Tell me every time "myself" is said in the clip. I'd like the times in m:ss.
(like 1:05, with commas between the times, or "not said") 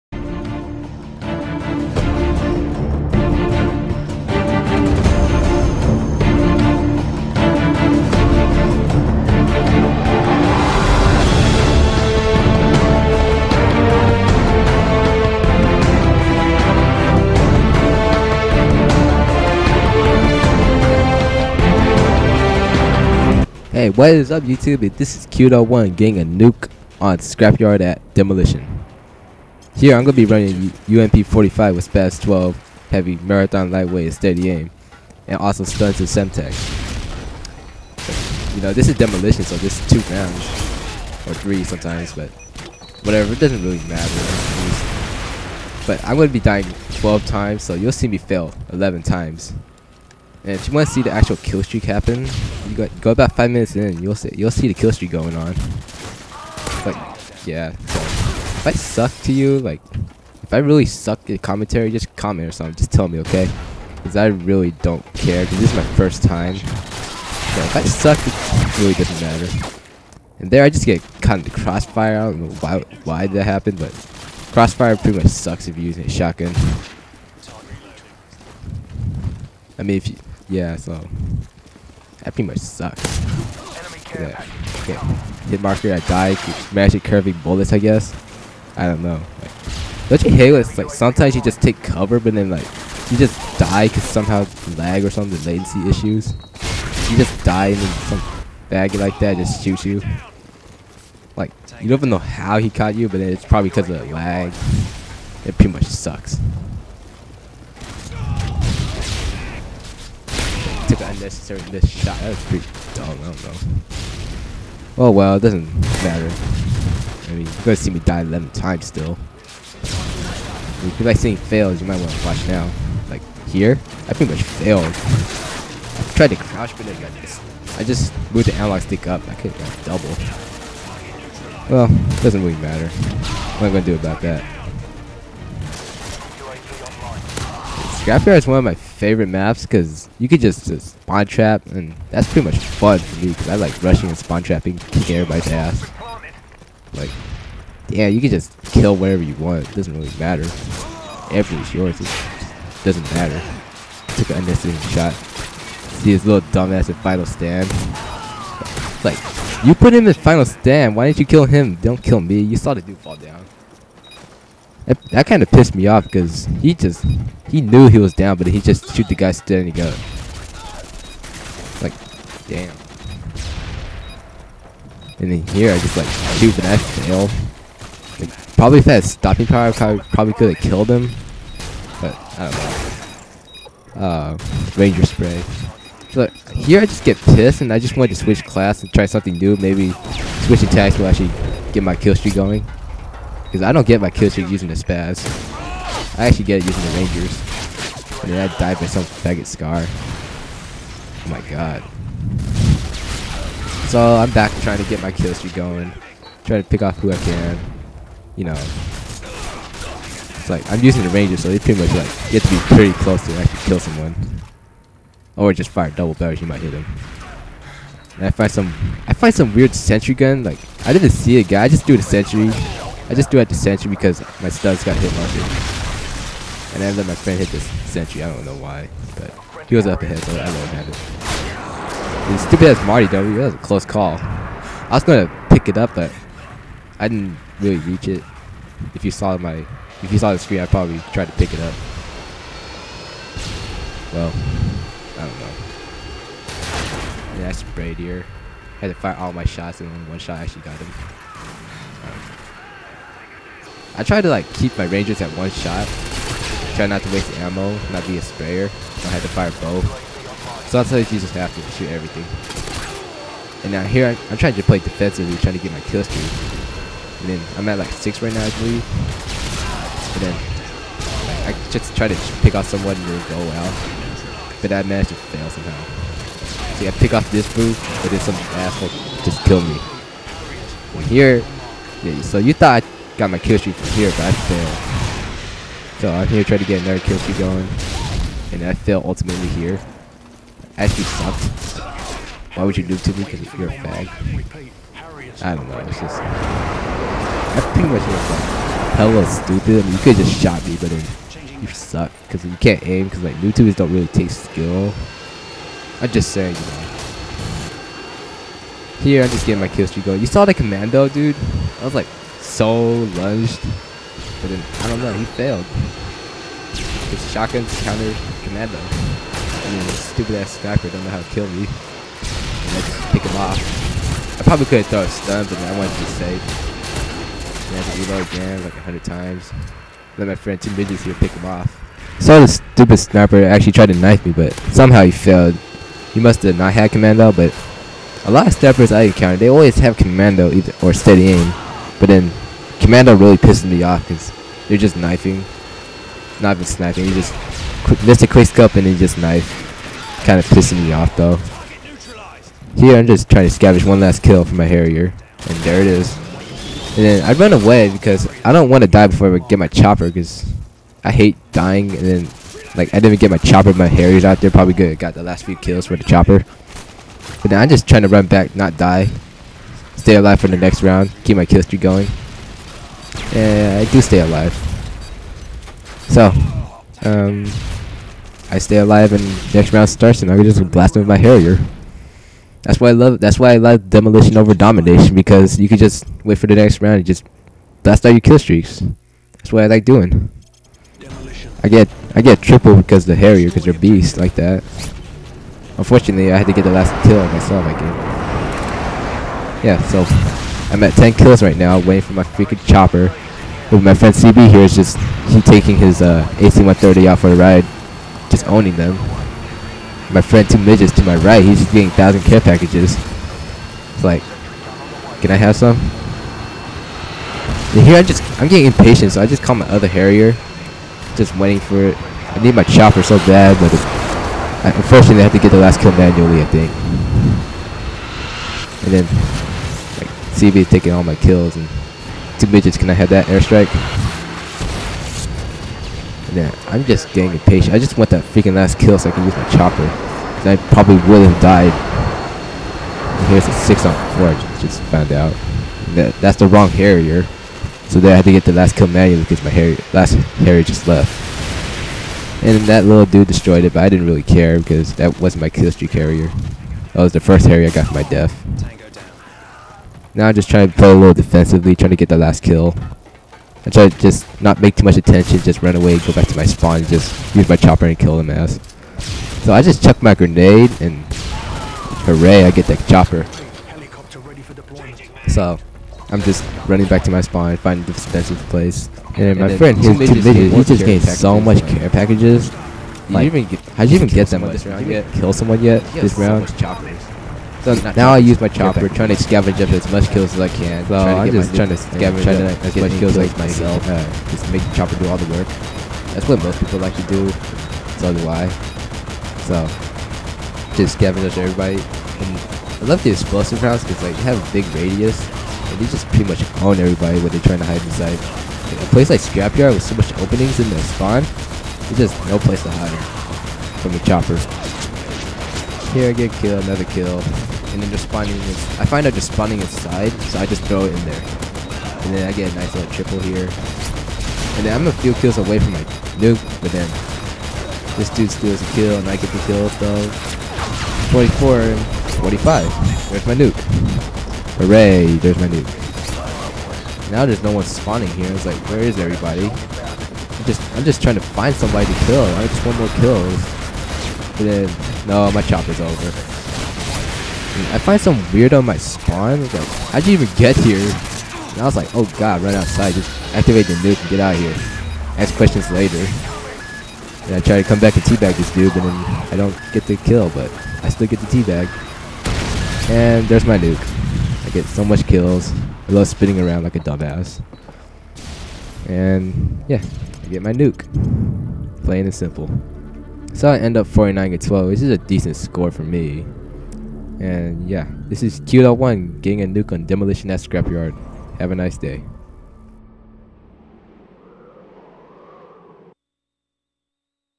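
6:37, 8:13.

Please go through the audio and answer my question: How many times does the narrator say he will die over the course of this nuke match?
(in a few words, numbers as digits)
12.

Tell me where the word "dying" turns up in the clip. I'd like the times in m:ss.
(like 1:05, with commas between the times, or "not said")
0:46, 6:01.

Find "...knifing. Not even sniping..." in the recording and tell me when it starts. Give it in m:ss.
5:44.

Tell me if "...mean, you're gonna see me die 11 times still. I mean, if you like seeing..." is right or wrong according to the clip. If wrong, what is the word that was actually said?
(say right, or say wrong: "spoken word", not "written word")
right.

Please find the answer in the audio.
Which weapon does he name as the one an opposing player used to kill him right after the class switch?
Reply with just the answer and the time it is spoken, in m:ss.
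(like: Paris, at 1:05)
Scar, at 3:19.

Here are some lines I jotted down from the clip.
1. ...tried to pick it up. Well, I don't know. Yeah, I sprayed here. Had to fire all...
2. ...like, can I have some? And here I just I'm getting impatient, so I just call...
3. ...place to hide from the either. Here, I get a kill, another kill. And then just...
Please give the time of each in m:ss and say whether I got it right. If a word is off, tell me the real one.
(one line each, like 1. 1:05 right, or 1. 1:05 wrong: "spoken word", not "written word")
1. 4:01 right
2. 6:54 right
3. 8:32 wrong: "chopper", not "either".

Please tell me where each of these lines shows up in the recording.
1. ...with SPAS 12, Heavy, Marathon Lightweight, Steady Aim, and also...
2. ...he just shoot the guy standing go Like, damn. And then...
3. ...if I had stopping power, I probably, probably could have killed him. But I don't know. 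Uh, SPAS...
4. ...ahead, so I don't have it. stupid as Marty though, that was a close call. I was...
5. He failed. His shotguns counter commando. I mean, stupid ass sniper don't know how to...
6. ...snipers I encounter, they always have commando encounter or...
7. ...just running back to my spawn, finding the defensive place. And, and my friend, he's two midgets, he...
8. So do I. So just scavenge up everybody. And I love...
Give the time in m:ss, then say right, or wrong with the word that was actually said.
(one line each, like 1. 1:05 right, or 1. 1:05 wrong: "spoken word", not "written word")
1. 0:31 right
2. 2:48 right
3. 2:58 wrong: "Ranger", not "SPAS"
4. 3:50 right
5. 5:15 right
6. 5:38 wrong: "either", not "encounter"
7. 7:56 right
8. 8:17 right.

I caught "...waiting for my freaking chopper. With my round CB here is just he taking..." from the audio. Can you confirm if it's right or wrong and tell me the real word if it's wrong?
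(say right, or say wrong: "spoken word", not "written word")
wrong: "friend", not "round".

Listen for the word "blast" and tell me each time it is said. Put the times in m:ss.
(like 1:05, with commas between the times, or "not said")
6:20, 6:27.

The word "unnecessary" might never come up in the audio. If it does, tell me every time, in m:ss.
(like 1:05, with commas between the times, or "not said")
1:51, 2:34.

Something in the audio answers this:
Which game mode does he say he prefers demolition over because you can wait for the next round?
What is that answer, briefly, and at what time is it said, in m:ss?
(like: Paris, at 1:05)
Domination, at 6:24.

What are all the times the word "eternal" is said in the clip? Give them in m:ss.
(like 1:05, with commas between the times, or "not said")
not said.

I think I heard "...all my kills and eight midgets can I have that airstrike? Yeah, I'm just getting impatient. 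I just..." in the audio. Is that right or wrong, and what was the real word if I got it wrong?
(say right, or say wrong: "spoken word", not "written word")
wrong: "two", not "eight".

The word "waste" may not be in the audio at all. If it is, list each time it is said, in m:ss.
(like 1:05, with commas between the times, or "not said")
4:17.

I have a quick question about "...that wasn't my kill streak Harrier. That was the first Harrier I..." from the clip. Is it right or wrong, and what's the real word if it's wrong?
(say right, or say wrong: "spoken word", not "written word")
right.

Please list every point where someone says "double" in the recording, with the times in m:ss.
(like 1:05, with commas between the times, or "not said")
2:09, 3:35.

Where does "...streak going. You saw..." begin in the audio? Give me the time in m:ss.
5:09.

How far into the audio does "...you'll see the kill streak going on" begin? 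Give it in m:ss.
0:54.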